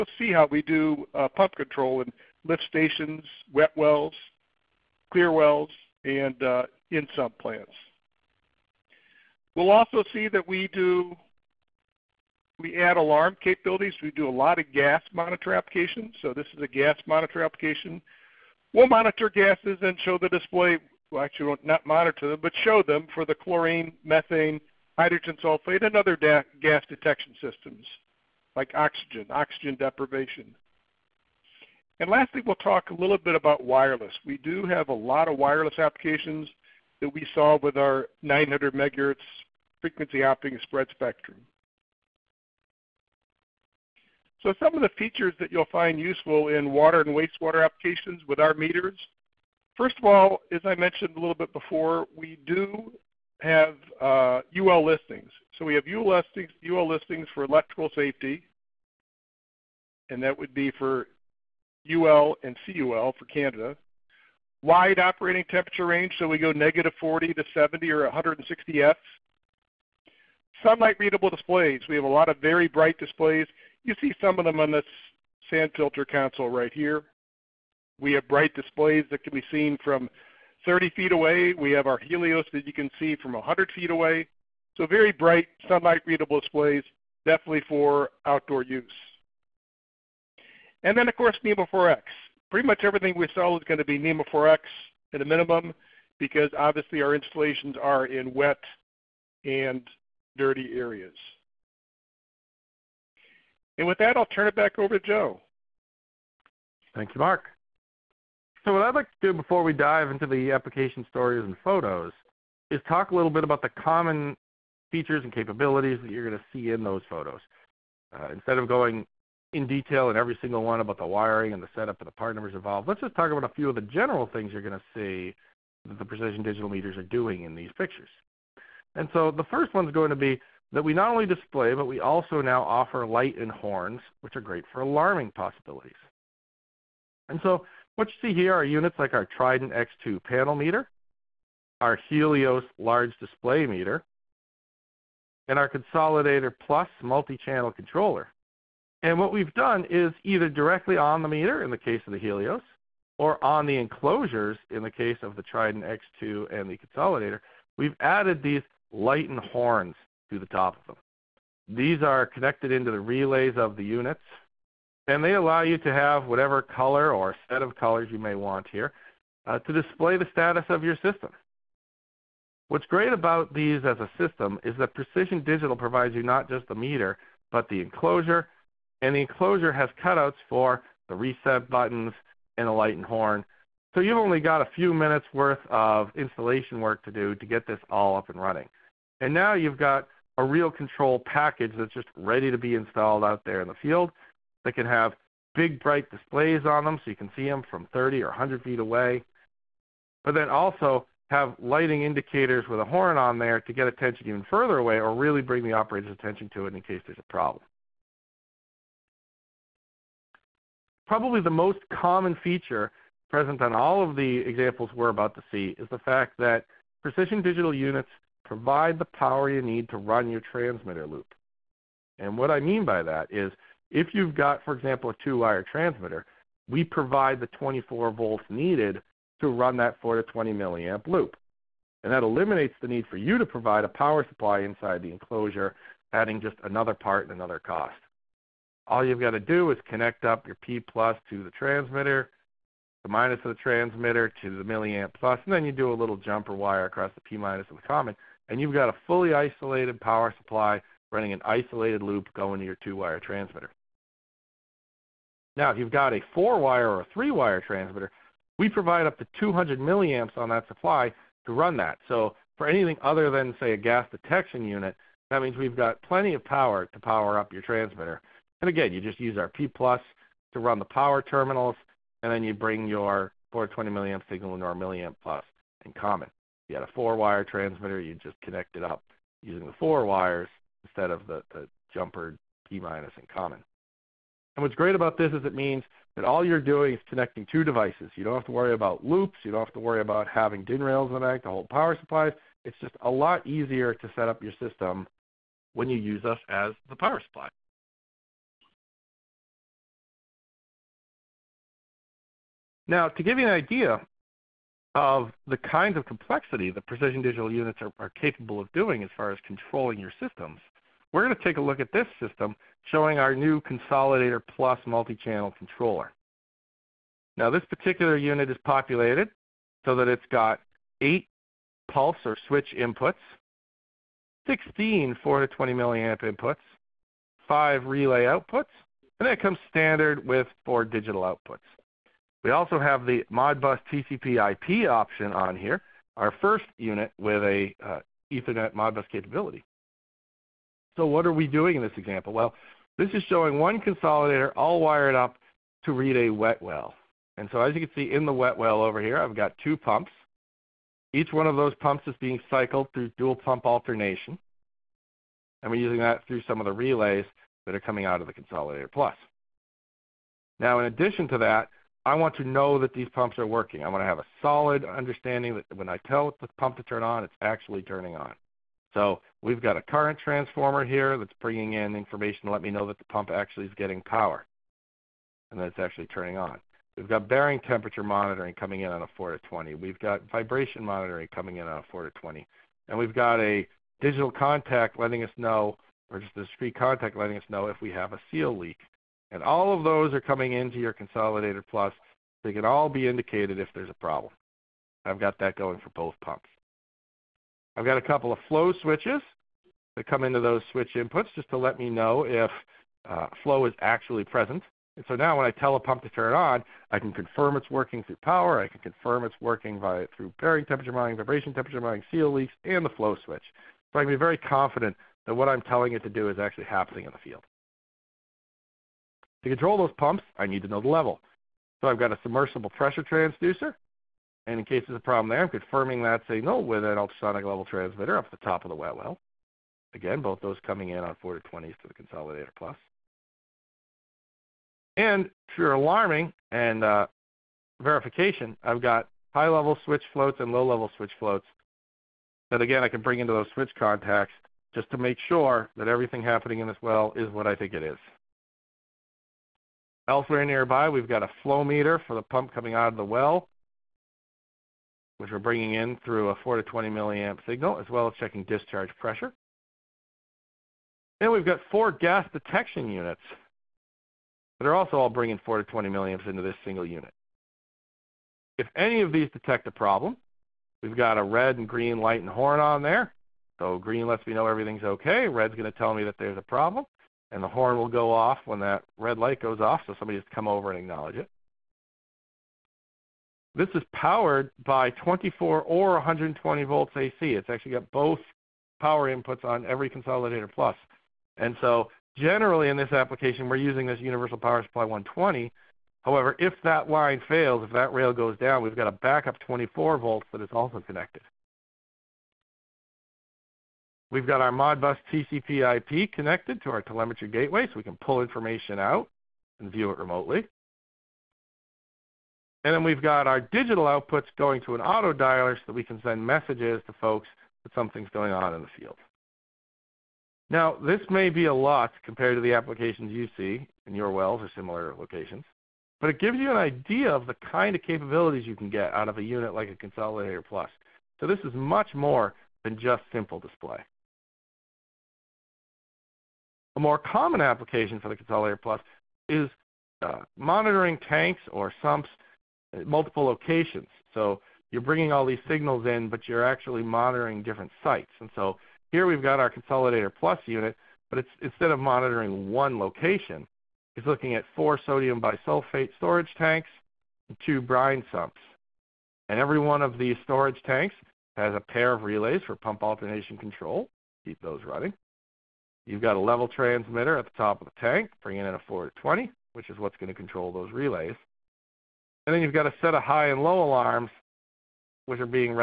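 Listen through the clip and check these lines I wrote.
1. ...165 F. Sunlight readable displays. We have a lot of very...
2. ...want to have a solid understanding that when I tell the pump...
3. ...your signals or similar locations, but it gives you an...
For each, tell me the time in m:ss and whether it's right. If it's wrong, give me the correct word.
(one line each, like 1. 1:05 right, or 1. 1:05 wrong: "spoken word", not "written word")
1. 1:08 wrong: "160", not "165"
2. 6:03 right
3. 8:43 wrong: "wells", not "signals".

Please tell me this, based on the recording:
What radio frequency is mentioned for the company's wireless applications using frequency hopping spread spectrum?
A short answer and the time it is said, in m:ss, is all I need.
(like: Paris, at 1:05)
900 megahertz, at 0:38.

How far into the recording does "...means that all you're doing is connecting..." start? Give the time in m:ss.
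4:45.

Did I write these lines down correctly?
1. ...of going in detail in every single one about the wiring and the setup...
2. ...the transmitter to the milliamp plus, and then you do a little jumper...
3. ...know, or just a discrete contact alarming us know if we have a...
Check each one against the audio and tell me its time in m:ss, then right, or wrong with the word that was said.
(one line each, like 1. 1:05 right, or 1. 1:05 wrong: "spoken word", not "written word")
1. 1:58 right
2. 4:03 right
3. 6:25 wrong: "letting", not "alarming".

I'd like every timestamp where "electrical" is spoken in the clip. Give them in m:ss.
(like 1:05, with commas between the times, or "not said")
0:57.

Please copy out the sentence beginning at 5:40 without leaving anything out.
So what are we doing in this example?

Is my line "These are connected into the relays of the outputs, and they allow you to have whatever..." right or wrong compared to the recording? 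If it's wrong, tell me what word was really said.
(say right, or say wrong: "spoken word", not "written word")
wrong: "units", not "outputs".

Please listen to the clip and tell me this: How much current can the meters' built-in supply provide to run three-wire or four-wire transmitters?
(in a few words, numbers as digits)
200 milliamps.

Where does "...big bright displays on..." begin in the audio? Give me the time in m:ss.
3:15.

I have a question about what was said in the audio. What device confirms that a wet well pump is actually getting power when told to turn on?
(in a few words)
current transformer.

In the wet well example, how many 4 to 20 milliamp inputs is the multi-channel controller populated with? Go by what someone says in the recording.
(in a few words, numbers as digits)
16.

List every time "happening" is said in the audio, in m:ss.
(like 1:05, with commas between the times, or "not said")
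6:56, 7:26.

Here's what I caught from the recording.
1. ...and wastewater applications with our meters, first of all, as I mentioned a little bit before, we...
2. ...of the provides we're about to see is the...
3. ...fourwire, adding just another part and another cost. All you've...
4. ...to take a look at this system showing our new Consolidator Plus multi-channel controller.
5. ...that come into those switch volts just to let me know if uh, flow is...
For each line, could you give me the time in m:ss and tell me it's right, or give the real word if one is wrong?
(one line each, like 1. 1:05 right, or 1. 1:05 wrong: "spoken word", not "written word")
1. 0:47 right
2. 3:34 wrong: "examples", not "provides"
3. 3:55 wrong: "enclosure", not "fourwire"
4. 5:11 right
5. 6:39 wrong: "inputs", not "volts".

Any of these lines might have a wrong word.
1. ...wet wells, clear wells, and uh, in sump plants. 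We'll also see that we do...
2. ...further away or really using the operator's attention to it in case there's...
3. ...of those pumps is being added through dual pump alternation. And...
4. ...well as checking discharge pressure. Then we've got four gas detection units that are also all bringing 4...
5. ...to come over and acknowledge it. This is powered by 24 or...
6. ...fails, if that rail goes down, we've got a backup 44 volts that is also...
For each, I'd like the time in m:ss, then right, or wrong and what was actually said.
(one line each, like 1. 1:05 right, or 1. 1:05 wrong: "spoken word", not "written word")
1. 0:03 right
2. 3:24 wrong: "bring", not "using"
3. 5:51 wrong: "cycled", not "added"
4. 7:37 right
5. 8:00 right
6. 8:17 wrong: "24", not "44".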